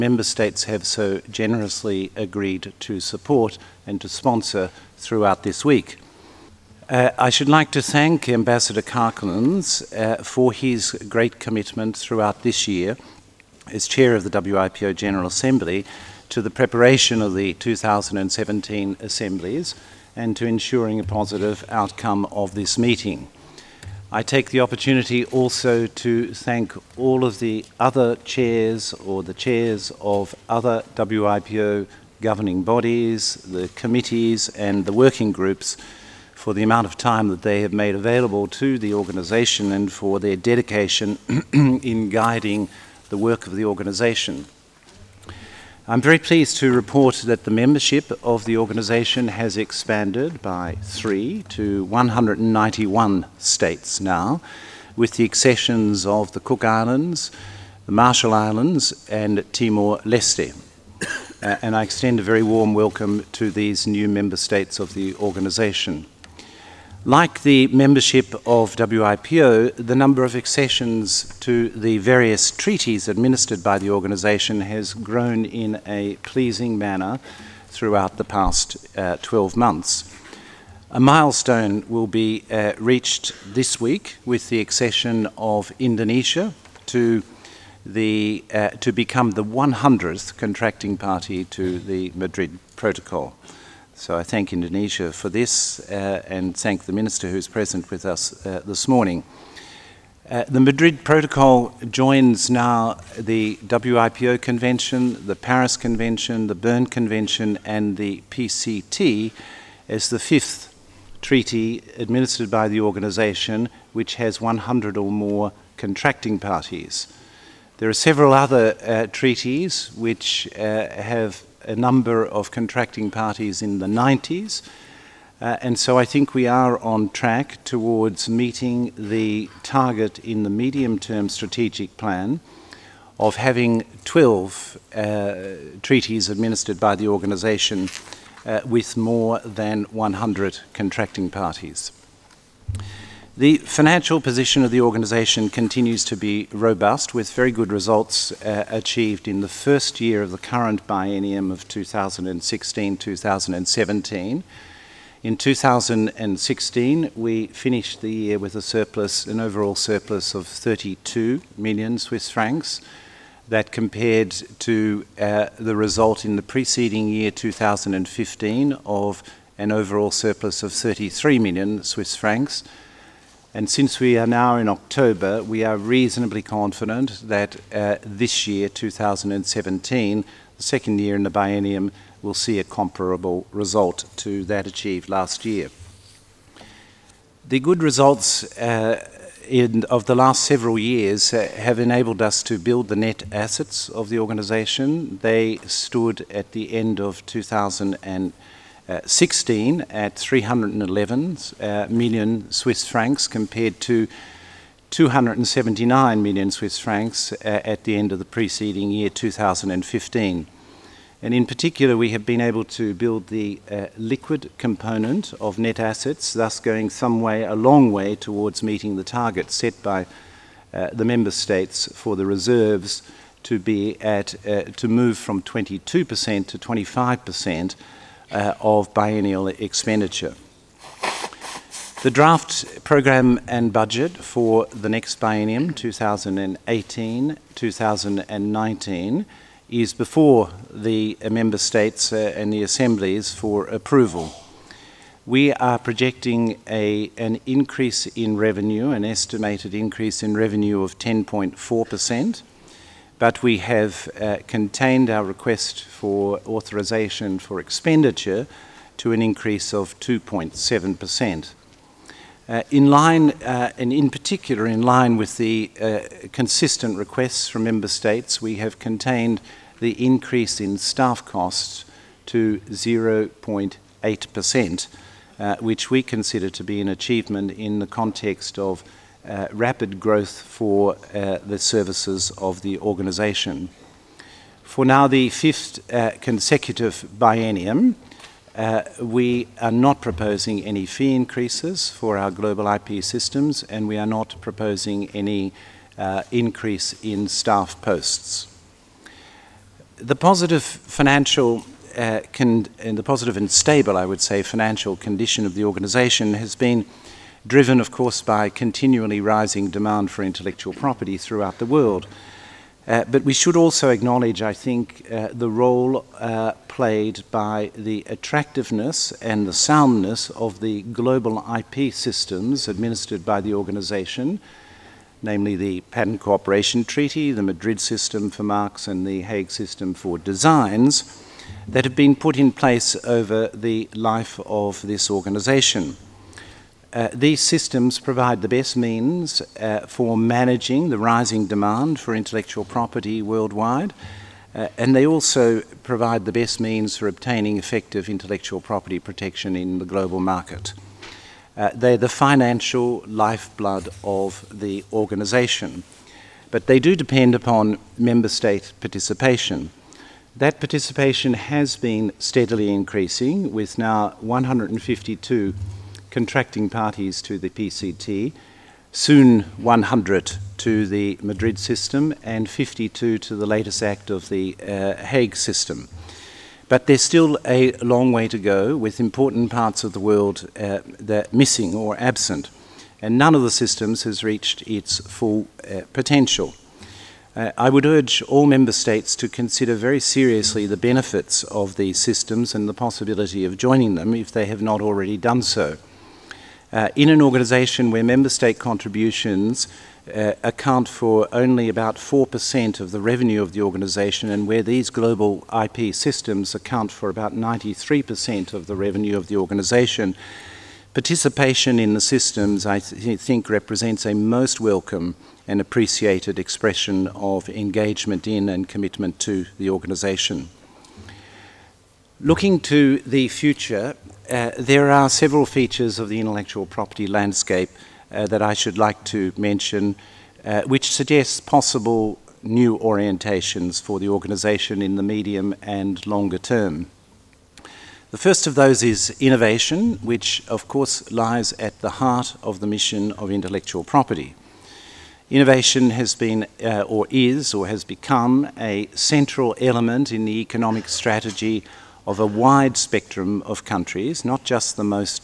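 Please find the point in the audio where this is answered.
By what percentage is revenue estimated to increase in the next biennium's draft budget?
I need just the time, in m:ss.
4:10.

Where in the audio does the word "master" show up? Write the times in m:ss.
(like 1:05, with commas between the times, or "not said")
not said.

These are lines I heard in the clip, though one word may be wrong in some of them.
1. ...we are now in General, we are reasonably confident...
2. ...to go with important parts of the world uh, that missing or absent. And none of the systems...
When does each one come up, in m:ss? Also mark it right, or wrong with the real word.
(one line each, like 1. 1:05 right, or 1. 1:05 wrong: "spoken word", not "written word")
1. 2:53 wrong: "October", not "General"
2. 6:18 right.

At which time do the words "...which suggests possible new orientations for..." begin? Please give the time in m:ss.
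7:10.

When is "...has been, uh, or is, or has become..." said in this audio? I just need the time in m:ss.
7:25.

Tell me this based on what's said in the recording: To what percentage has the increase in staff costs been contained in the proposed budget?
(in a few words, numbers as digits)
0.8%.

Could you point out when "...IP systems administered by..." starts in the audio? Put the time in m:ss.
5:21.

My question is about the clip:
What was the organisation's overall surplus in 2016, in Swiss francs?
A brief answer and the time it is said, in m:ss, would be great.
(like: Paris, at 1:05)
32 million, at 2:40.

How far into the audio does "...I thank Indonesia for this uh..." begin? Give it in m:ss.
1:34.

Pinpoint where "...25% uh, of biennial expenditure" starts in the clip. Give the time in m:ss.
3:46.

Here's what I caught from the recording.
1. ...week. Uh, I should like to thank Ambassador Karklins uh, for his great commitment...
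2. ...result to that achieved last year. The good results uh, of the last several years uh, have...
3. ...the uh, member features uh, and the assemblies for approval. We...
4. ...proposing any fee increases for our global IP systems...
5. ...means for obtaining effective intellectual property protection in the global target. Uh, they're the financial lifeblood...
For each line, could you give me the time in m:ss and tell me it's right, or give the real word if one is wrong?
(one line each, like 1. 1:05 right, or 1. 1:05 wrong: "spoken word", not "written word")
1. 0:05 right
2. 3:03 right
3. 4:00 wrong: "states", not "features"
4. 4:50 right
5. 5:46 wrong: "market", not "target".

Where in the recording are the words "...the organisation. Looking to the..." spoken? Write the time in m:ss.
6:59.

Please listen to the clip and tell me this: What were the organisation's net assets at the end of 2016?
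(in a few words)
311 million Swiss francs.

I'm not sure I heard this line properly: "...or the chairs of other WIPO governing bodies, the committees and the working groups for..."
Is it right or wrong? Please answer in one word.
right.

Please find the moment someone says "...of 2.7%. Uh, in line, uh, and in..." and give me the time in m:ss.
4:19.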